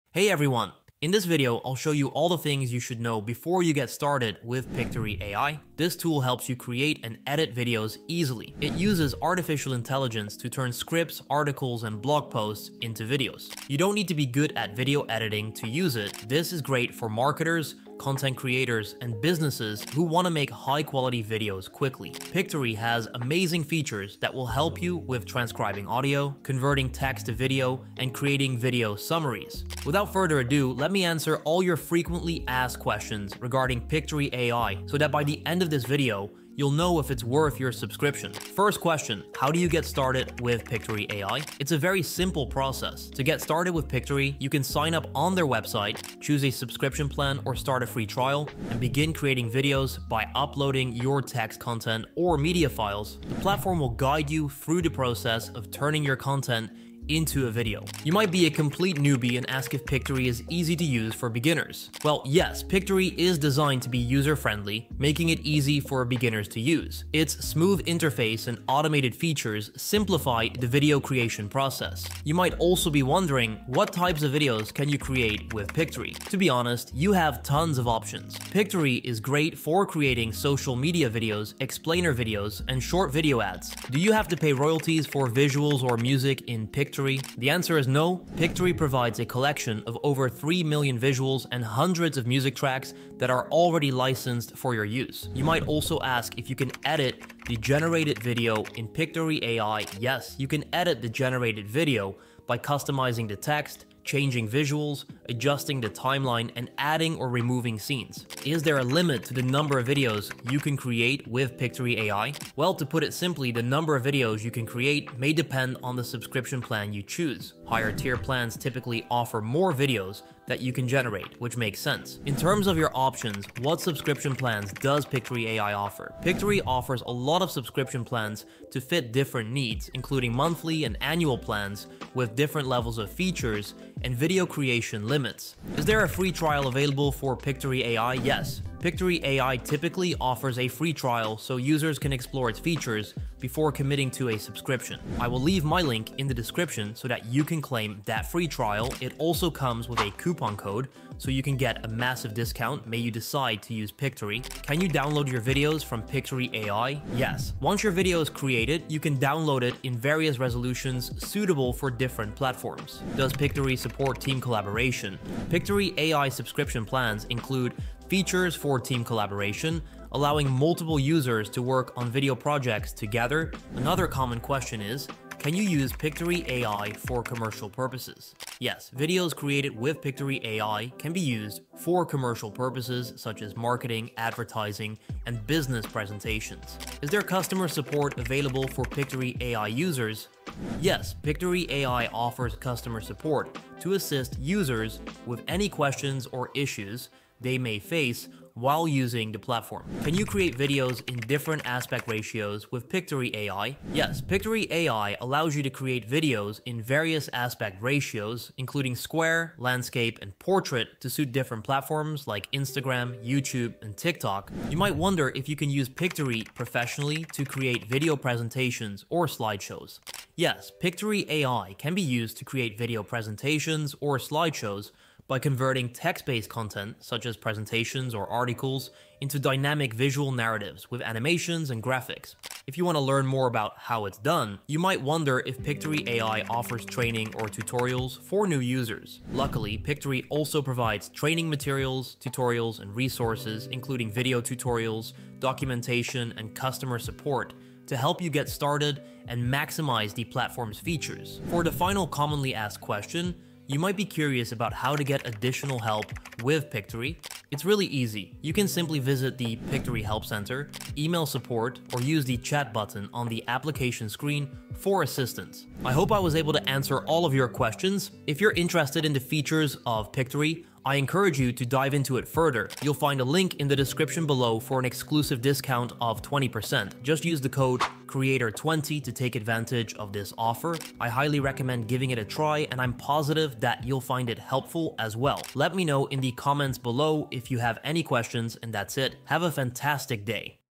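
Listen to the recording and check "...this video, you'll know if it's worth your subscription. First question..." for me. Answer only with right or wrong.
right.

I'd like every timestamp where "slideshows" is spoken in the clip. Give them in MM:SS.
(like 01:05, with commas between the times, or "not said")
03:39, 03:44.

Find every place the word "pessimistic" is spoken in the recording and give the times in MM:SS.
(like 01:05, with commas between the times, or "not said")
not said.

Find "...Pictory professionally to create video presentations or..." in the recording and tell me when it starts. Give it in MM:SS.
03:35.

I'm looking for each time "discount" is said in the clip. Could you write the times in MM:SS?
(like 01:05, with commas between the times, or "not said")
02:32, 04:35.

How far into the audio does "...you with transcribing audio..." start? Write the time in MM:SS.
00:24.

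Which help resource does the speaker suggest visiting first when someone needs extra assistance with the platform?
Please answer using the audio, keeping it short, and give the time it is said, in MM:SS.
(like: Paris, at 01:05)
Pictory Help Center, at 04:19.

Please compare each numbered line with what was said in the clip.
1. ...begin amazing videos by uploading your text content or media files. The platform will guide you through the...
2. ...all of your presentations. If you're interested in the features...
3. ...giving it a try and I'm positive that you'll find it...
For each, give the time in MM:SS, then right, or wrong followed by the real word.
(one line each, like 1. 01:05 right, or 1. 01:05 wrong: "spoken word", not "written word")
1. 00:48 wrong: "creating", not "amazing"
2. 04:27 wrong: "questions", not "presentations"
3. 04:41 right.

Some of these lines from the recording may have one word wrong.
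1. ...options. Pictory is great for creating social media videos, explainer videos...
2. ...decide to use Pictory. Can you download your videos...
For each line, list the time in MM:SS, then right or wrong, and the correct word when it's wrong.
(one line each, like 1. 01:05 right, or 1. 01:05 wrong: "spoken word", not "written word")
1. 01:17 right
2. 02:33 right.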